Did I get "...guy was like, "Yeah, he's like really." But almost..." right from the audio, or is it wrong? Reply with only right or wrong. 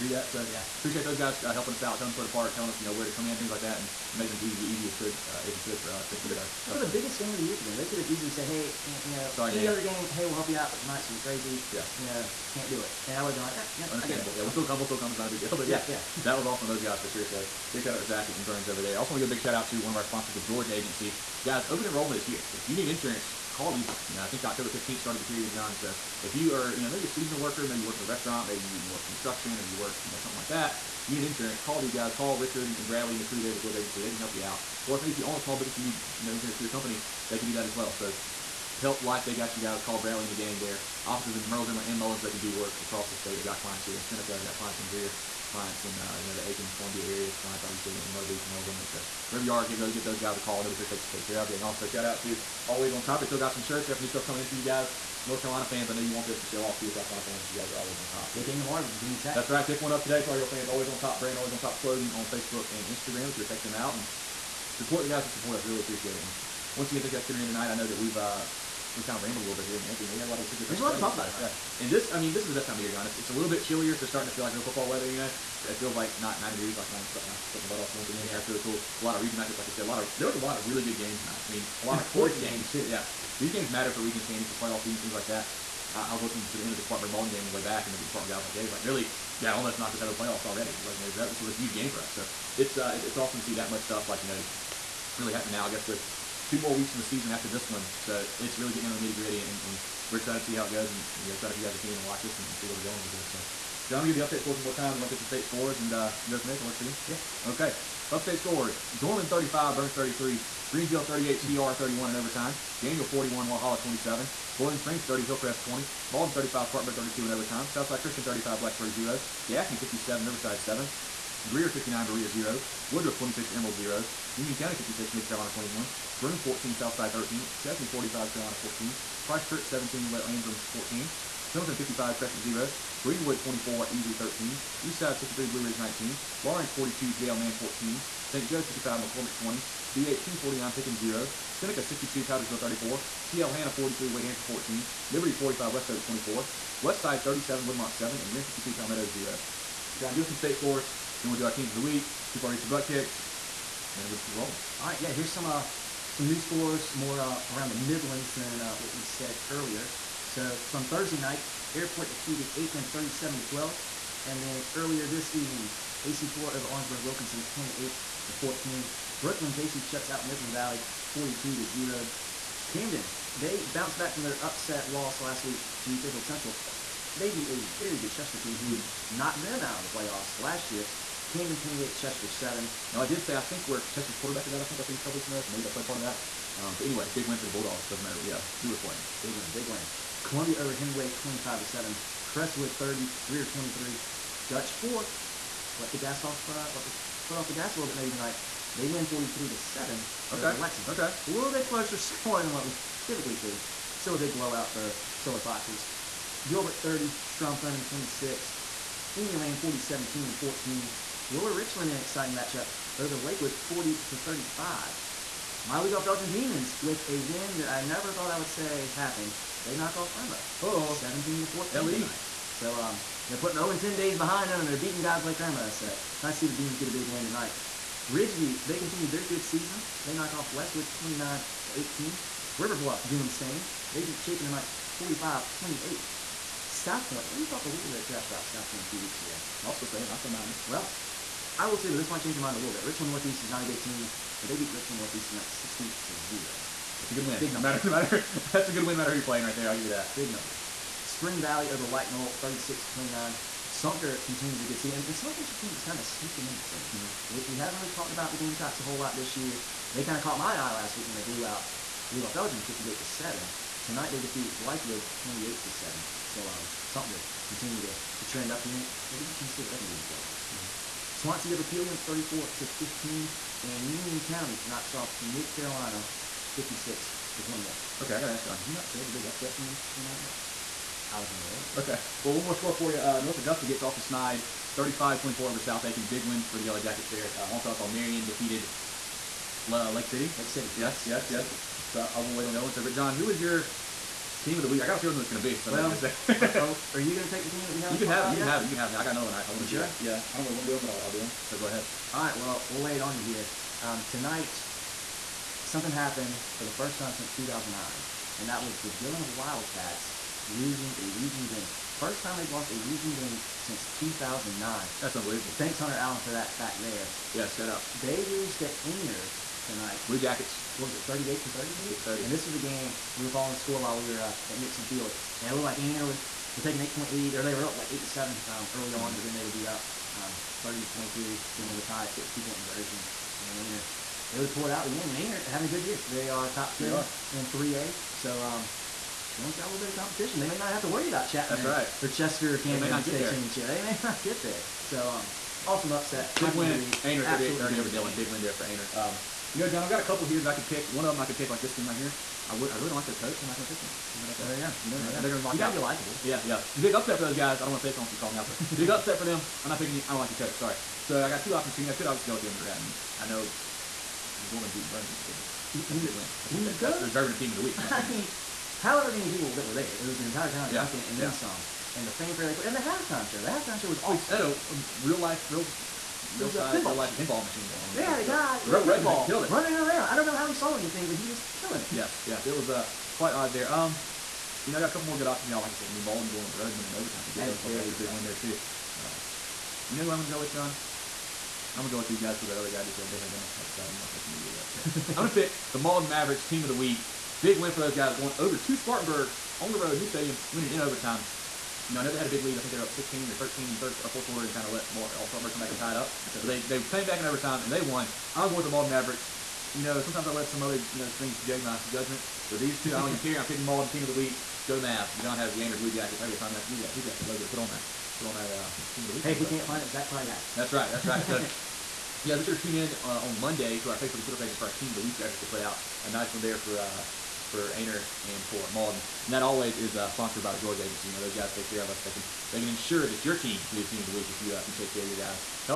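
wrong.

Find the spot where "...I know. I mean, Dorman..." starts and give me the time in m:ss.
6:03.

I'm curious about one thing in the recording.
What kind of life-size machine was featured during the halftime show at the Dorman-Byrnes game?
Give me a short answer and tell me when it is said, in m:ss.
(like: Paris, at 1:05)
Pinball machine, at 6:17.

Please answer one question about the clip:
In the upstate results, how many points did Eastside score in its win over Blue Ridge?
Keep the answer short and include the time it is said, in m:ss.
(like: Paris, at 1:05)
63, at 2:14.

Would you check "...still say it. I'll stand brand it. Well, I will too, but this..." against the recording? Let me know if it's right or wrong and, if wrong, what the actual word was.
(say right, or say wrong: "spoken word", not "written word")
wrong: "behind", not "brand".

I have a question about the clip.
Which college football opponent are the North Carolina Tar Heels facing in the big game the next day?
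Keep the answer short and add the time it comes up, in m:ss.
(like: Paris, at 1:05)
Virginia Tech, at 0:58.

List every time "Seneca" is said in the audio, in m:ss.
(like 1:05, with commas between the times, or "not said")
0:44, 2:21.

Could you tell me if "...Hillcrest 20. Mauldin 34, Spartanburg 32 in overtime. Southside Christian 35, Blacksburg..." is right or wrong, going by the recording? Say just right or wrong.
wrong.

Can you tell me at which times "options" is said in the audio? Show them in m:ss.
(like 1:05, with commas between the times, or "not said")
6:01, 6:25.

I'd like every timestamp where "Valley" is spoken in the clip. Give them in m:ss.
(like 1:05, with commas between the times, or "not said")
2:50, 4:11.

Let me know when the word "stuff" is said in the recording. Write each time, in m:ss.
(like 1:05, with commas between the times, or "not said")
0:06, 0:54, 1:10, 1:33.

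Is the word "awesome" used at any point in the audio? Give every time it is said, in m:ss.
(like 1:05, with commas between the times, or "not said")
0:16, 1:33, 5:45, 6:13.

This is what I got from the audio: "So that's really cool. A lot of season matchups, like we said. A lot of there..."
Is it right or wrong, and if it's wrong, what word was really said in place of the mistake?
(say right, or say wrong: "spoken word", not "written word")
wrong: "region", not "season".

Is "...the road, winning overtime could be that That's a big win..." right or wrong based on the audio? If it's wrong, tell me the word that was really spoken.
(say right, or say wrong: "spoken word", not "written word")
right.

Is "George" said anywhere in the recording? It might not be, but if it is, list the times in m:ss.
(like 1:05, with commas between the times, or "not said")
0:20, 0:33, 7:10.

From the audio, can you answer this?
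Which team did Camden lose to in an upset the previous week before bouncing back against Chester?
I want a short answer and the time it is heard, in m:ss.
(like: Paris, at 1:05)
Fairfield Central, at 2:56.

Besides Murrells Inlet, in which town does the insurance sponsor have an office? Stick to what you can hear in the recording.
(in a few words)
Mullins.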